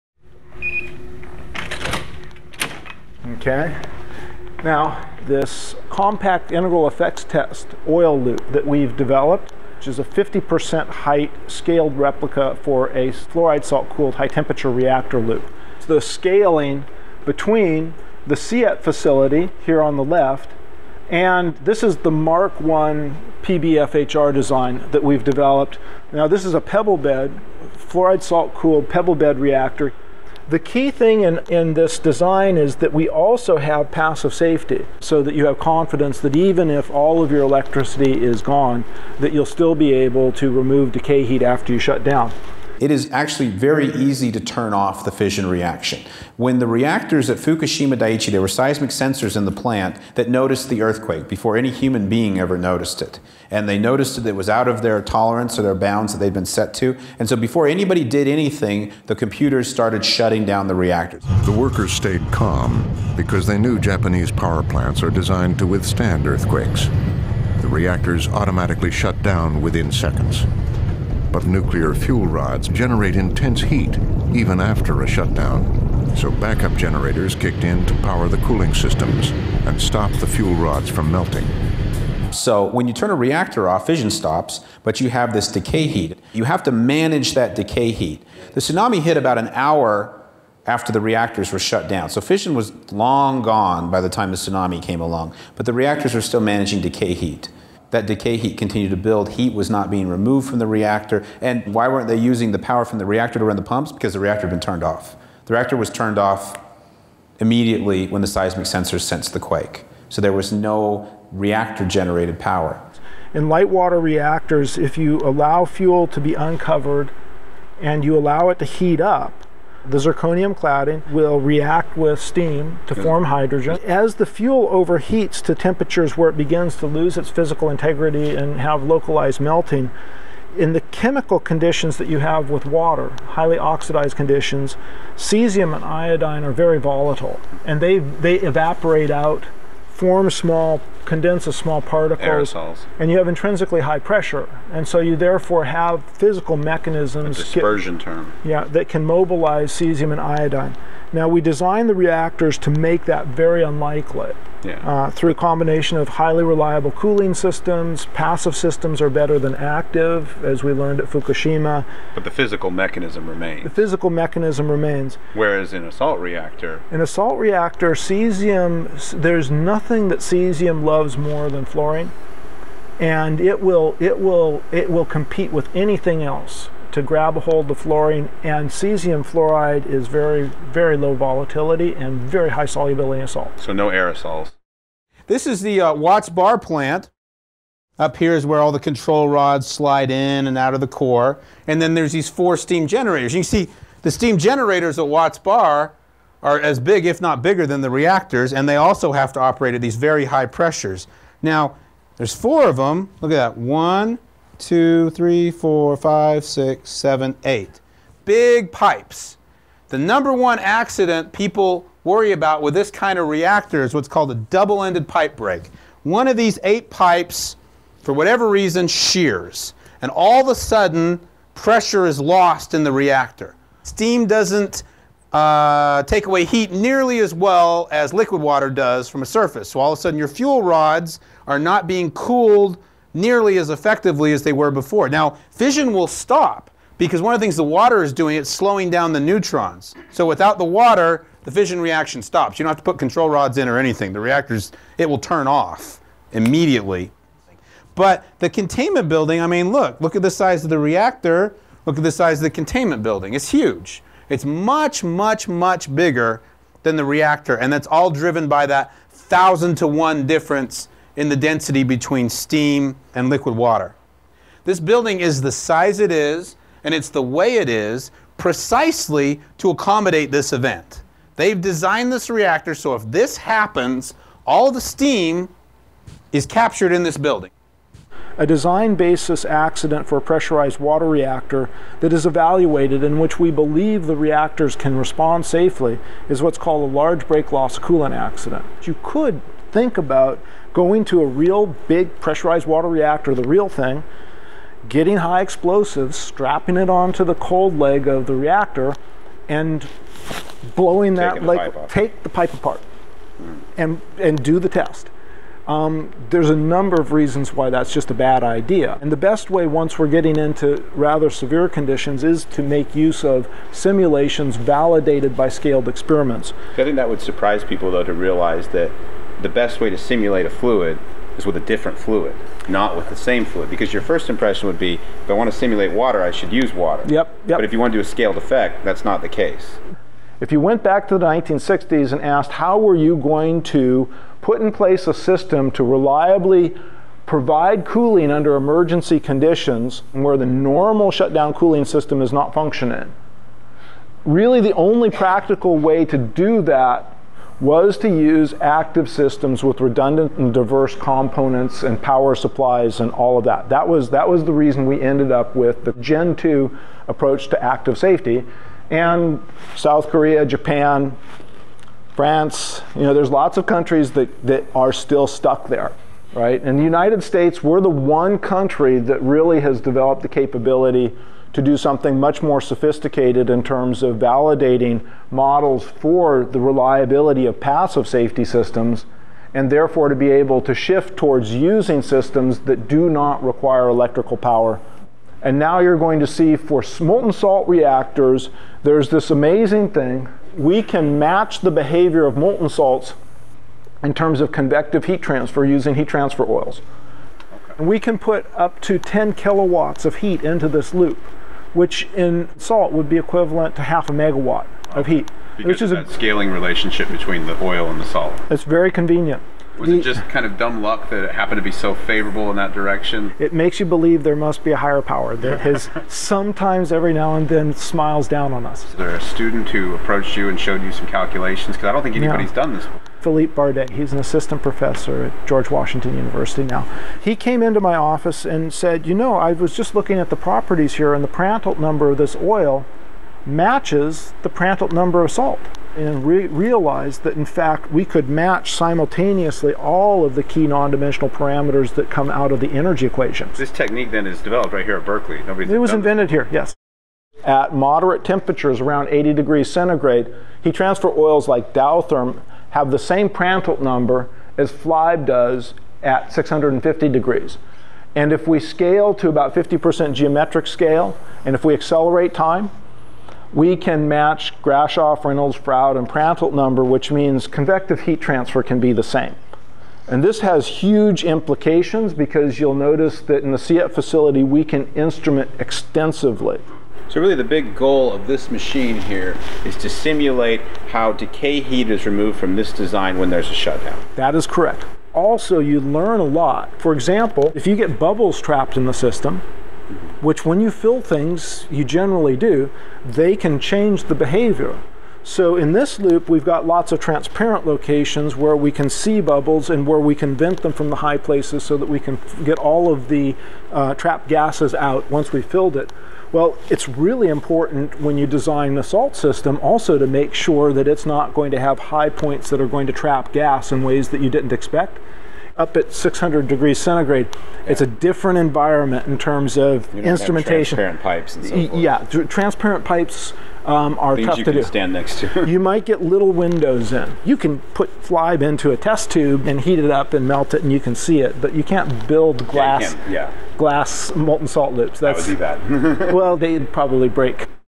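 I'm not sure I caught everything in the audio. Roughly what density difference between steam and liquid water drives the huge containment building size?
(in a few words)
1000 to 1.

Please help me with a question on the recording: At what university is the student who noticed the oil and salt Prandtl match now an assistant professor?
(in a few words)
George Washington University.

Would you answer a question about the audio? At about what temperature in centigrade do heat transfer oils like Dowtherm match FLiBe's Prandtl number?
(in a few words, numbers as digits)
80 degrees.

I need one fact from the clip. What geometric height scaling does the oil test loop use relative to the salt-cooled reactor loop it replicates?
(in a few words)
50%.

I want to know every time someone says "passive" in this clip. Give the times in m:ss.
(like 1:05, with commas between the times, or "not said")
0:33, 2:38, 6:17.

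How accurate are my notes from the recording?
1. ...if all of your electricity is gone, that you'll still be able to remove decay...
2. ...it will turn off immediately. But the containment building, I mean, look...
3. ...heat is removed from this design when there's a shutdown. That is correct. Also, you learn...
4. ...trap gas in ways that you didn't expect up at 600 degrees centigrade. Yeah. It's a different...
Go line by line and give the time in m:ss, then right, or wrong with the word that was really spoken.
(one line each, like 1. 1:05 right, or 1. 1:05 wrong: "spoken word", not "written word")
1. 0:36 right
2. 4:04 right
3. 8:01 right
4. 8:32 right.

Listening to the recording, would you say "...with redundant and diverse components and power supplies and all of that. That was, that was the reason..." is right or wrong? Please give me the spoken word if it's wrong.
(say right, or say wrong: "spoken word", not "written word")
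right.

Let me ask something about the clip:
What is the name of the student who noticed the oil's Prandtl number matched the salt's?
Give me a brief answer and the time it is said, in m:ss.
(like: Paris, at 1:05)
Philippe Bardet, at 7:03.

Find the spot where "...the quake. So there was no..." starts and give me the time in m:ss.
1:49.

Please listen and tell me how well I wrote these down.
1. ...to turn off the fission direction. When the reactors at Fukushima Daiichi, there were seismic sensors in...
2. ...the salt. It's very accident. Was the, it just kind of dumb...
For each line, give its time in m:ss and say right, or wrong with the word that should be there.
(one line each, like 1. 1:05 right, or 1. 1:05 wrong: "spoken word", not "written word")
1. 0:44 wrong: "reaction", not "direction"
2. 6:47 wrong: "convenient", not "accident".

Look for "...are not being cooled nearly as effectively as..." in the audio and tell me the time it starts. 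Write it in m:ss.
3:51.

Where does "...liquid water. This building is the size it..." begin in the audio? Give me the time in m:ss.
4:23.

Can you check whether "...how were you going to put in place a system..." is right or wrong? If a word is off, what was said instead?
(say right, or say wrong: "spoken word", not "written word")
right.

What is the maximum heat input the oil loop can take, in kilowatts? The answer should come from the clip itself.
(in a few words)
10 kilowatts.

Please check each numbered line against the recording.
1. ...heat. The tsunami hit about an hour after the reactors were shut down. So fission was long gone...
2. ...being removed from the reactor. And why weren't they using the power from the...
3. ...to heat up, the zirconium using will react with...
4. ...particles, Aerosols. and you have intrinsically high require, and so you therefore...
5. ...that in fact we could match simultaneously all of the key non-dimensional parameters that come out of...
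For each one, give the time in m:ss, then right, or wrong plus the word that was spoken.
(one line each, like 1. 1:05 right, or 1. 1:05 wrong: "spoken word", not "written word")
1. 1:27 right
2. 1:39 right
3. 1:58 wrong: "cladding", not "using"
4. 2:21 wrong: "pressure", not "require"
5. 7:17 right.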